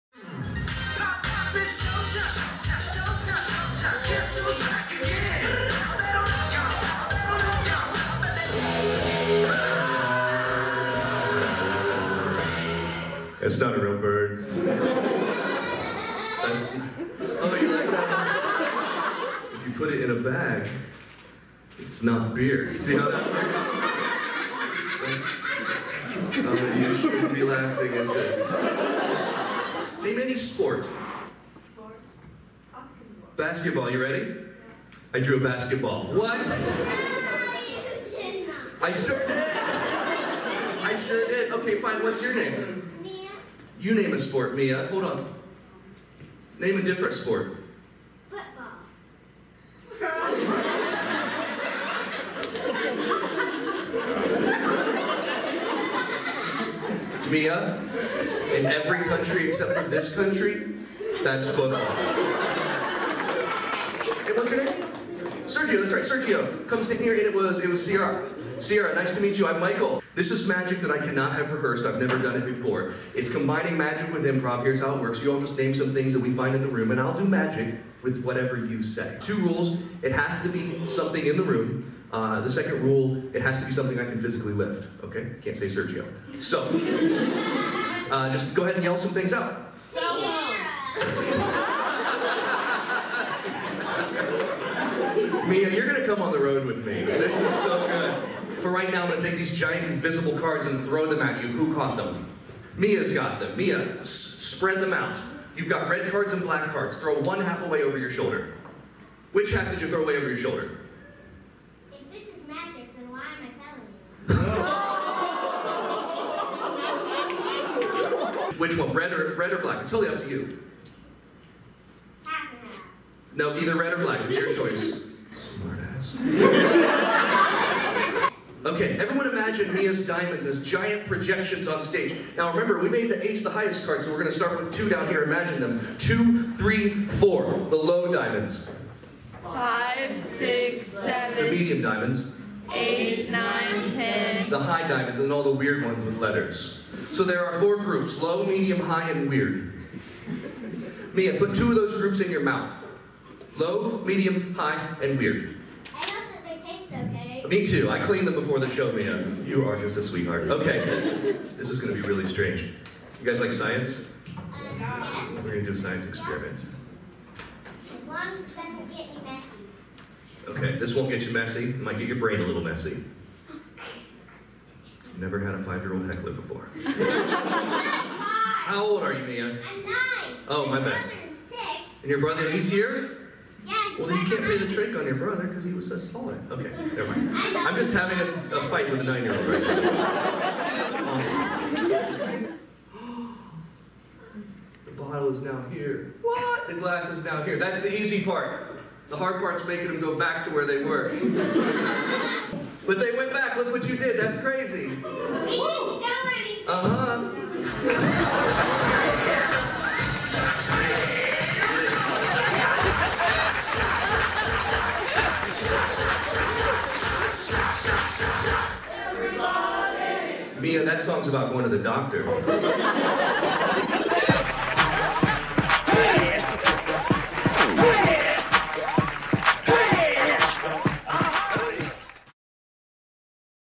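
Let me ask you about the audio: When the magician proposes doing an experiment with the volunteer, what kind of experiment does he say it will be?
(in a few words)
Science experiment.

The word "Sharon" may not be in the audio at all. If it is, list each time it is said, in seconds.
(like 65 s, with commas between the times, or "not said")
not said.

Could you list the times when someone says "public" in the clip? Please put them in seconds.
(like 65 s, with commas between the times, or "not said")
not said.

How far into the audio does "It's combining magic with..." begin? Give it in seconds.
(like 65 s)
73 s.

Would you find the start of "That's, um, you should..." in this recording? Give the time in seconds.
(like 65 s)
26 s.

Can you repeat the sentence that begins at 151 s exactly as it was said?
Mia, put two of those groups in your mouth.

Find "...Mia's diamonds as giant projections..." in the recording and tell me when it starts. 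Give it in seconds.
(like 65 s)
129 s.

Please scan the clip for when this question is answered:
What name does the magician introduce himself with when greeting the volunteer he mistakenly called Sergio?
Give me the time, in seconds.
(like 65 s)
69 s.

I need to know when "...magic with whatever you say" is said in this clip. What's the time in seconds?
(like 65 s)
77 s.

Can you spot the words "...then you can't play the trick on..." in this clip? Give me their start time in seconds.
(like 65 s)
184 s.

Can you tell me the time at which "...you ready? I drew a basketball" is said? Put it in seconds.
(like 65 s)
33 s.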